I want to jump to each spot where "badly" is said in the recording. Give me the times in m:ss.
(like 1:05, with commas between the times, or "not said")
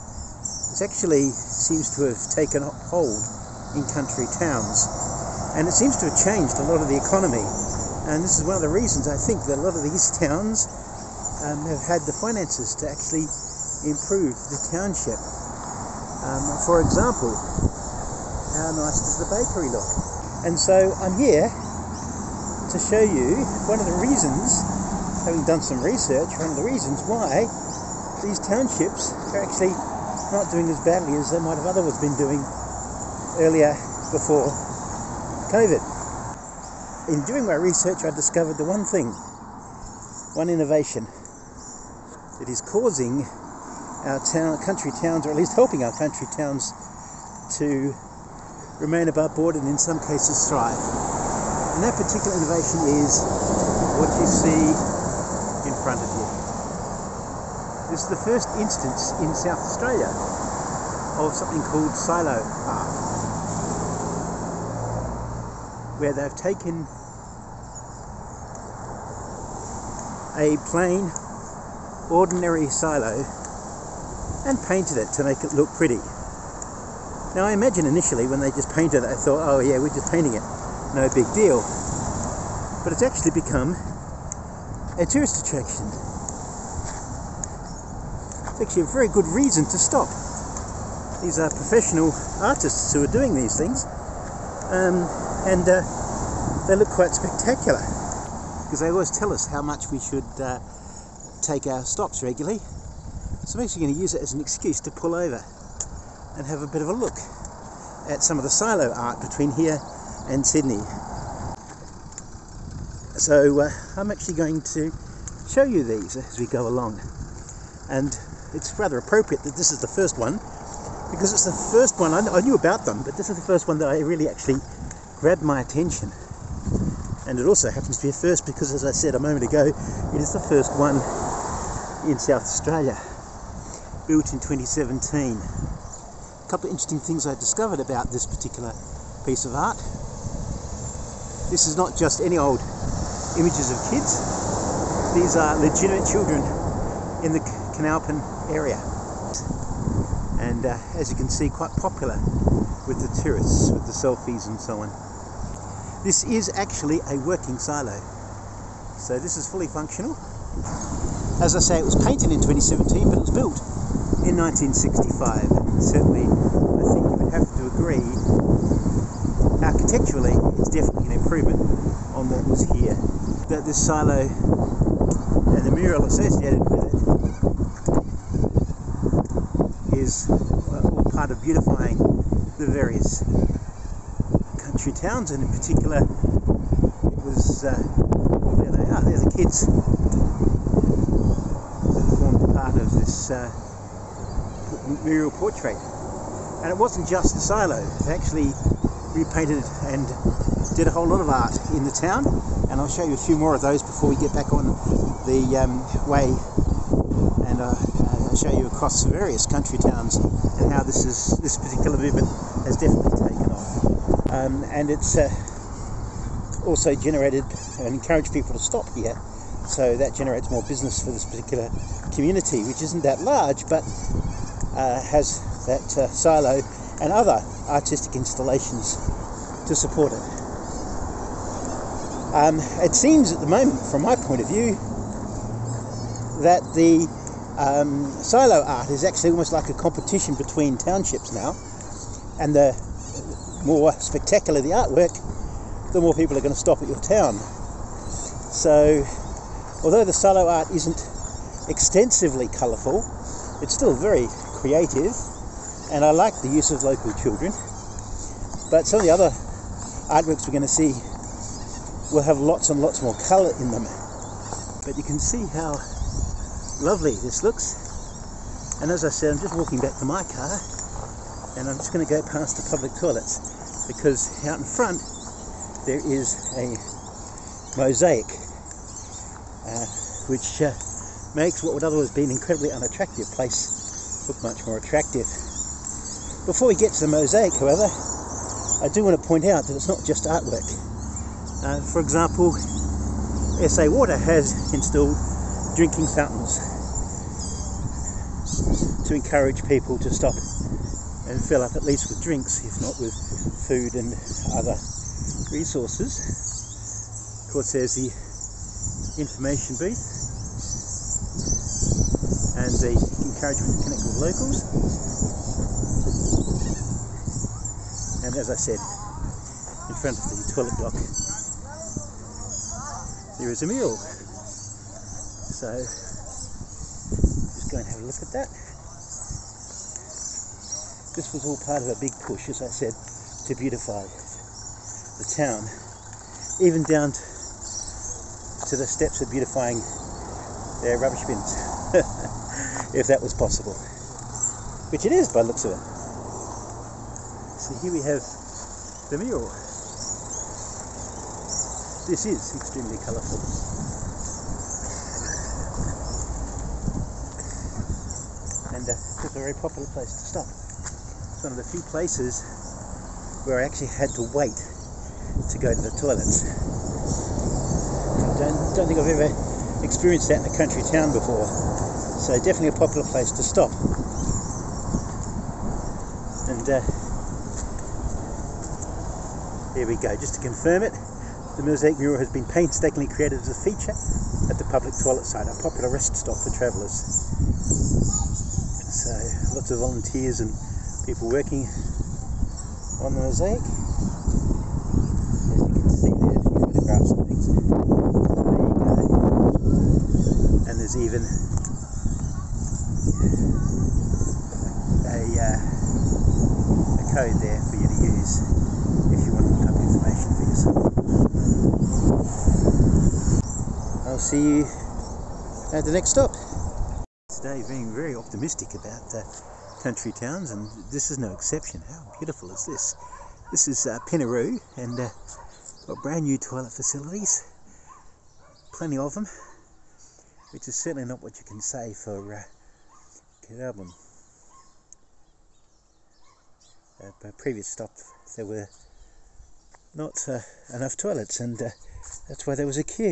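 0:30.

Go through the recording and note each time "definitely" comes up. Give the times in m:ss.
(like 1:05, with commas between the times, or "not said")
2:50, 3:32, 6:12.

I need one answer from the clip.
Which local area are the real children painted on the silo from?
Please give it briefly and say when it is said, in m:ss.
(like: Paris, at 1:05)
Coonalpyn, at 2:27.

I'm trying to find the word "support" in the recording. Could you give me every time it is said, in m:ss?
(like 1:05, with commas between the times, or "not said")
3:49.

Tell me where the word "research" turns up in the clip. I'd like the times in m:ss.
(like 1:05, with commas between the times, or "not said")
0:25, 0:37.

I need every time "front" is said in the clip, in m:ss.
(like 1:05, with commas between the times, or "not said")
4:34, 5:20.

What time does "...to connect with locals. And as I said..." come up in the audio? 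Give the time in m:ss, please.
5:13.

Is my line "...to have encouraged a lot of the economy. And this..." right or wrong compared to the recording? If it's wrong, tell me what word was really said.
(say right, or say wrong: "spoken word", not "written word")
wrong: "changed", not "encouraged".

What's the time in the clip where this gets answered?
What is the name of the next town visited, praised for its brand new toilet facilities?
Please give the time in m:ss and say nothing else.
7:04.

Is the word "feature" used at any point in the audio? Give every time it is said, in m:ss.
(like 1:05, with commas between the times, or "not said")
6:23.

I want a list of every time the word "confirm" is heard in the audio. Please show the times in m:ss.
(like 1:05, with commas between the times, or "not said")
6:20.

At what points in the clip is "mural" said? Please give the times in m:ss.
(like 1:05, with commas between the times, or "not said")
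2:55, 3:15, 6:21.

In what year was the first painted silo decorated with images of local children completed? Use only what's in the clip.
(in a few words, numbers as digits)
2017.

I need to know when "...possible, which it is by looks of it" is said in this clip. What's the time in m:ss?
5:43.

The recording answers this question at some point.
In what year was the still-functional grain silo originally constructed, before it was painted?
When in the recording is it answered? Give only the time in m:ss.
2:44.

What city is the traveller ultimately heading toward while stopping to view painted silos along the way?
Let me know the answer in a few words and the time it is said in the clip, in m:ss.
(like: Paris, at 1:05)
Sydney, at 1:50.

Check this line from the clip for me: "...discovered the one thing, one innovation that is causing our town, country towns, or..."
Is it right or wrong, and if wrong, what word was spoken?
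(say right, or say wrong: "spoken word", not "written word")
right.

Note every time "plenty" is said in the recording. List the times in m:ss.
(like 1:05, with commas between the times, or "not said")
7:08.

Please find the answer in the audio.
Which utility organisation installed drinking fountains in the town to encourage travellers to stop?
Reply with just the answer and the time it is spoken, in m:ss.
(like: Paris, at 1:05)
SA Water, at 4:53.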